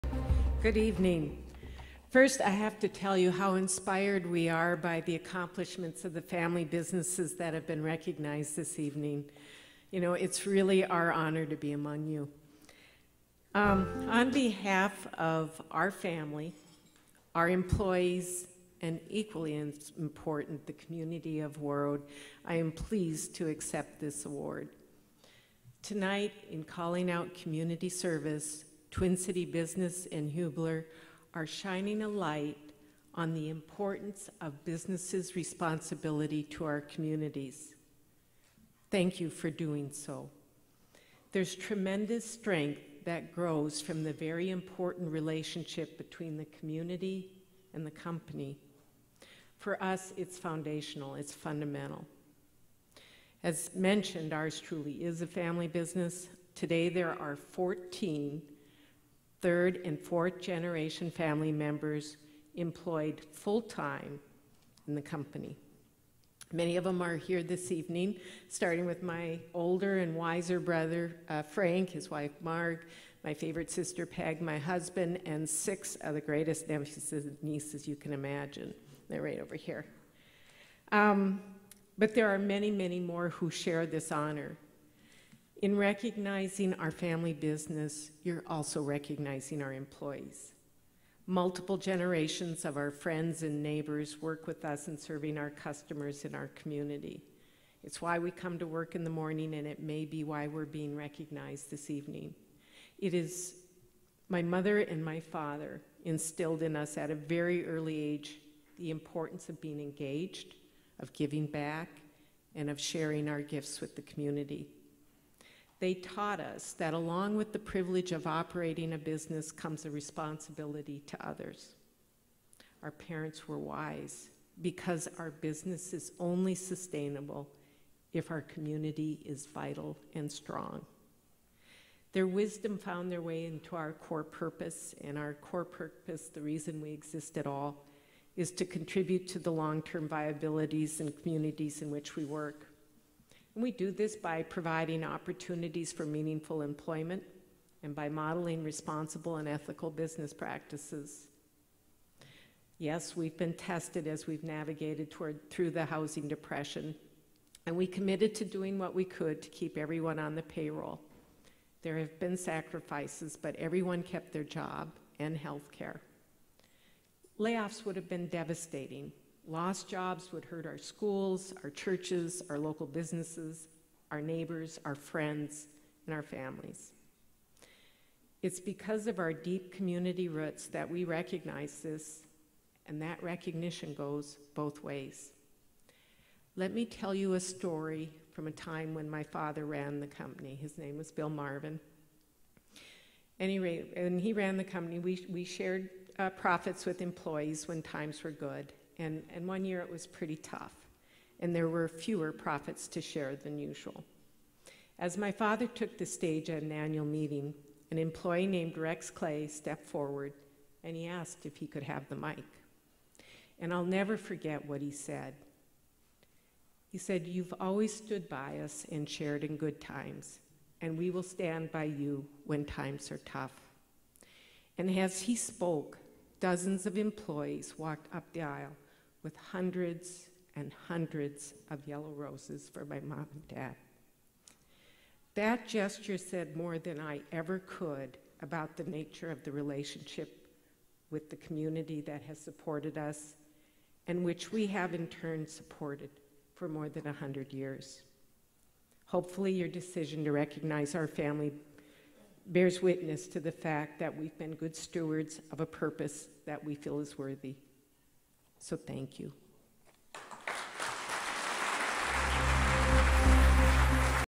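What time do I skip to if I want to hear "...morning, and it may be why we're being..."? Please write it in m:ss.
1:39.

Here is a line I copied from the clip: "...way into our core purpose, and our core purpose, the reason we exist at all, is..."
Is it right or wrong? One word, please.
right.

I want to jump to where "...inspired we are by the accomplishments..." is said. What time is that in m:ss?
0:03.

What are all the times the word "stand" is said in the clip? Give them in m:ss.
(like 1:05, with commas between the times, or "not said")
3:41.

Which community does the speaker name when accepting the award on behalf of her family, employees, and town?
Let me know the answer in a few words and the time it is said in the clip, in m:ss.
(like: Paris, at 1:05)
Warroad, at 0:21.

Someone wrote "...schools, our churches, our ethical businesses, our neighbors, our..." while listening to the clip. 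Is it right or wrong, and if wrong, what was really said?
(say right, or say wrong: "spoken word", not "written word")
wrong: "local", not "ethical".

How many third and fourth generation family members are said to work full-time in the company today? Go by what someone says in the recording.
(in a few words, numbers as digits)
14.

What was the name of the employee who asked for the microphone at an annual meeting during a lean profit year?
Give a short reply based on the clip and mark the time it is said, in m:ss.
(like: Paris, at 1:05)
Rex Clay, at 3:28.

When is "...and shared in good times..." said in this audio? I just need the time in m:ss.
3:38.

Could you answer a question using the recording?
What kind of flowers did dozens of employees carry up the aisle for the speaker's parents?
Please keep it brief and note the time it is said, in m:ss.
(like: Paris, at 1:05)
Yellow roses, at 3:51.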